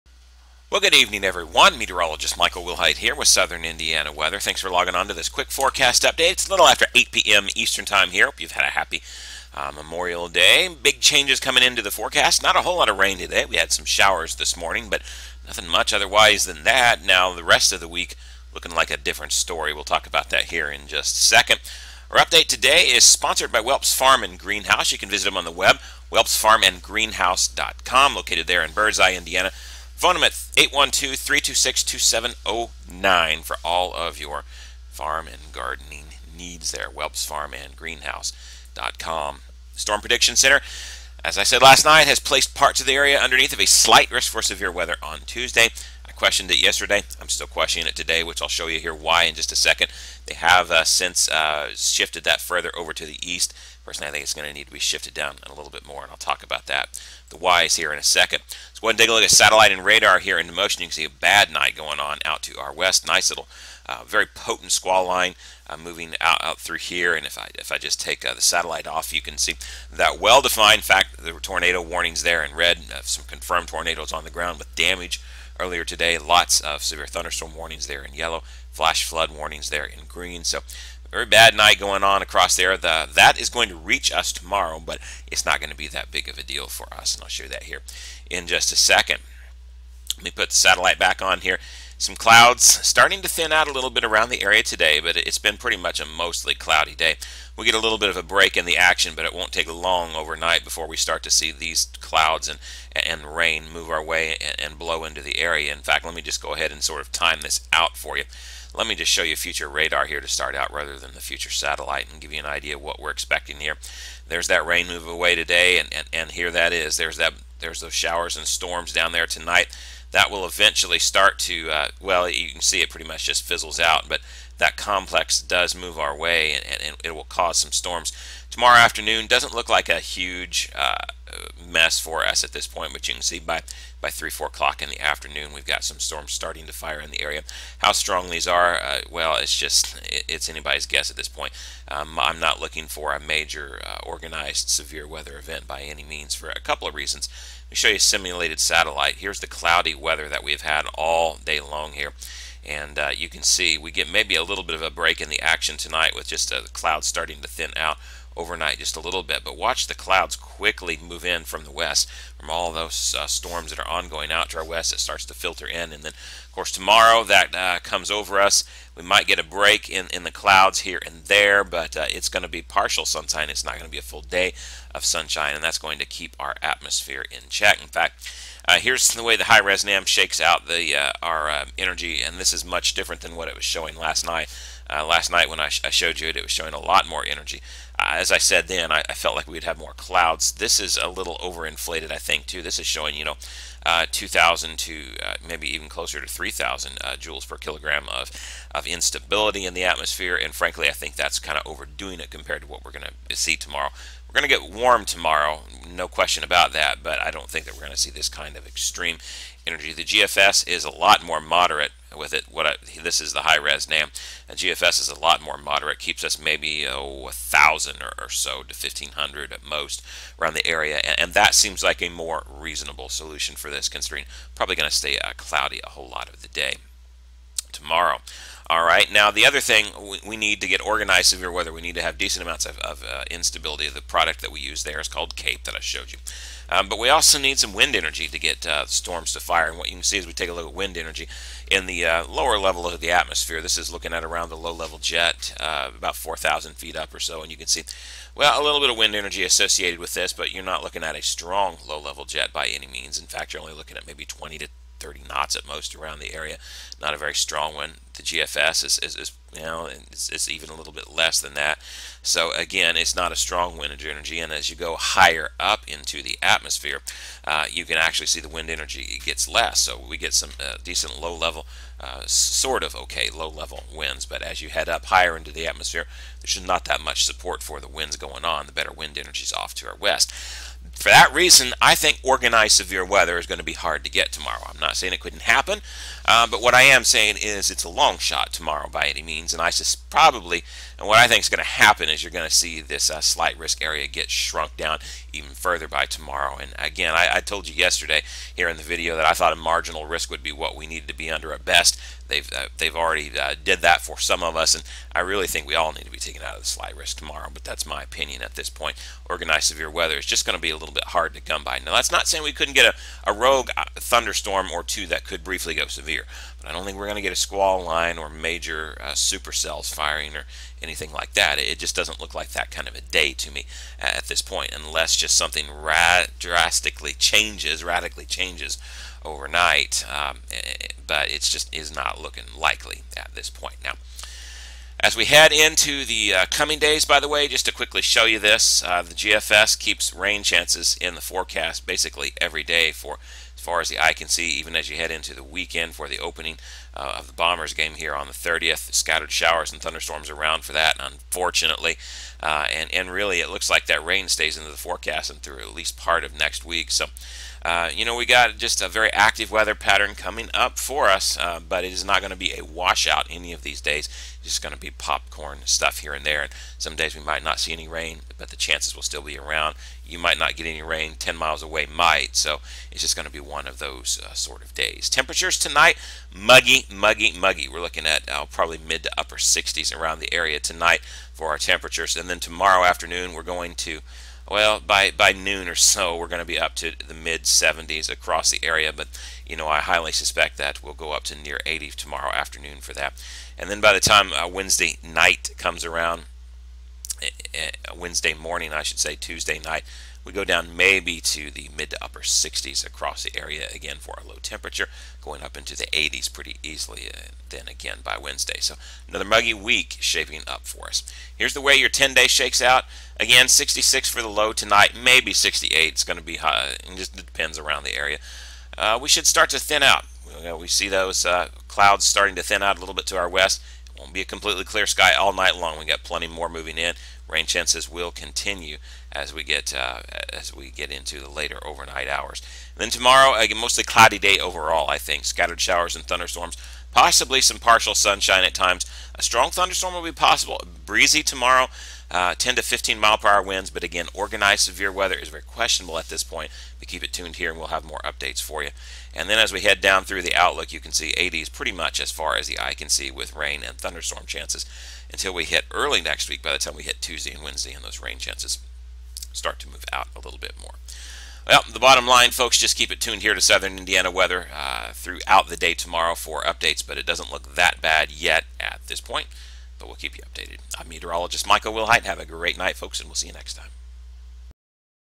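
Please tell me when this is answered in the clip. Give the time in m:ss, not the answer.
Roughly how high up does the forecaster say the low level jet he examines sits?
4:06.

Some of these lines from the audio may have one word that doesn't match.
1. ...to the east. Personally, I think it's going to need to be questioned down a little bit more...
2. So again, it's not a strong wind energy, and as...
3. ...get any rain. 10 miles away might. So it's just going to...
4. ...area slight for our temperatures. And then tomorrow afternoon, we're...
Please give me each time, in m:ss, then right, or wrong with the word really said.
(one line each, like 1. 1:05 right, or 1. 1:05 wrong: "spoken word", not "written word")
1. 0:52 wrong: "shifted", not "questioned"
2. 4:22 right
3. 6:10 right
4. 6:20 wrong: "tonight", not "slight".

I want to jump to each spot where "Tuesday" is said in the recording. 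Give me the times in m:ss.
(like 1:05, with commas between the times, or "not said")
0:45, 6:39, 7:37.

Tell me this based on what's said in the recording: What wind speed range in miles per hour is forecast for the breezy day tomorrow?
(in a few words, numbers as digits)
10 to 15.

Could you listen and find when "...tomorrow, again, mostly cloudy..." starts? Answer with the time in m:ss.
7:12.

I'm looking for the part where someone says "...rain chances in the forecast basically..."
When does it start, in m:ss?
5:40.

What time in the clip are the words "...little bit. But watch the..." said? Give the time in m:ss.
2:39.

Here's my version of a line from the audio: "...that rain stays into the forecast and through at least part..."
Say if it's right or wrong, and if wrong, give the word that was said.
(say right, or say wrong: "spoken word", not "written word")
right.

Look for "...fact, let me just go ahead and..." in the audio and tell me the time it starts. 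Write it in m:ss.
1:45.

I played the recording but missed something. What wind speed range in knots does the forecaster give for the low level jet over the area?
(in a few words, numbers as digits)
20 to 30 knots.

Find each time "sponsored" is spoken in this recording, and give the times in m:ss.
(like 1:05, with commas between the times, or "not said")
0:23.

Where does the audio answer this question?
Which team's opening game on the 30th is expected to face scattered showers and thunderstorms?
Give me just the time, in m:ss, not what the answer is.
5:47.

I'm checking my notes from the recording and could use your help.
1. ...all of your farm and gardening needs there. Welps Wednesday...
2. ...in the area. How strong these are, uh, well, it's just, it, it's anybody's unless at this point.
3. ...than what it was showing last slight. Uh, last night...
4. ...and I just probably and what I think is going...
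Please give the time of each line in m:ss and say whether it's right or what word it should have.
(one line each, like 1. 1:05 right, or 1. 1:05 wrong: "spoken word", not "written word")
1. 0:33 wrong: "Farm", not "Wednesday"
2. 2:16 wrong: "guess", not "unless"
3. 3:03 wrong: "night", not "slight"
4. 4:49 right.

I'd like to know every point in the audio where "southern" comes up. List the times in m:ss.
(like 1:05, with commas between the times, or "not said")
0:03, 7:43.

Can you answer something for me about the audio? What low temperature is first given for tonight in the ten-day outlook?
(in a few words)
66.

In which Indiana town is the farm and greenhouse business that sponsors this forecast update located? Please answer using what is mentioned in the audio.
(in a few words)
Birdseye.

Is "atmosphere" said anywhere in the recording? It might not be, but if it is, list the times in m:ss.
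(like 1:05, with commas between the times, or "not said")
2:56, 3:19, 4:03, 4:26, 4:35.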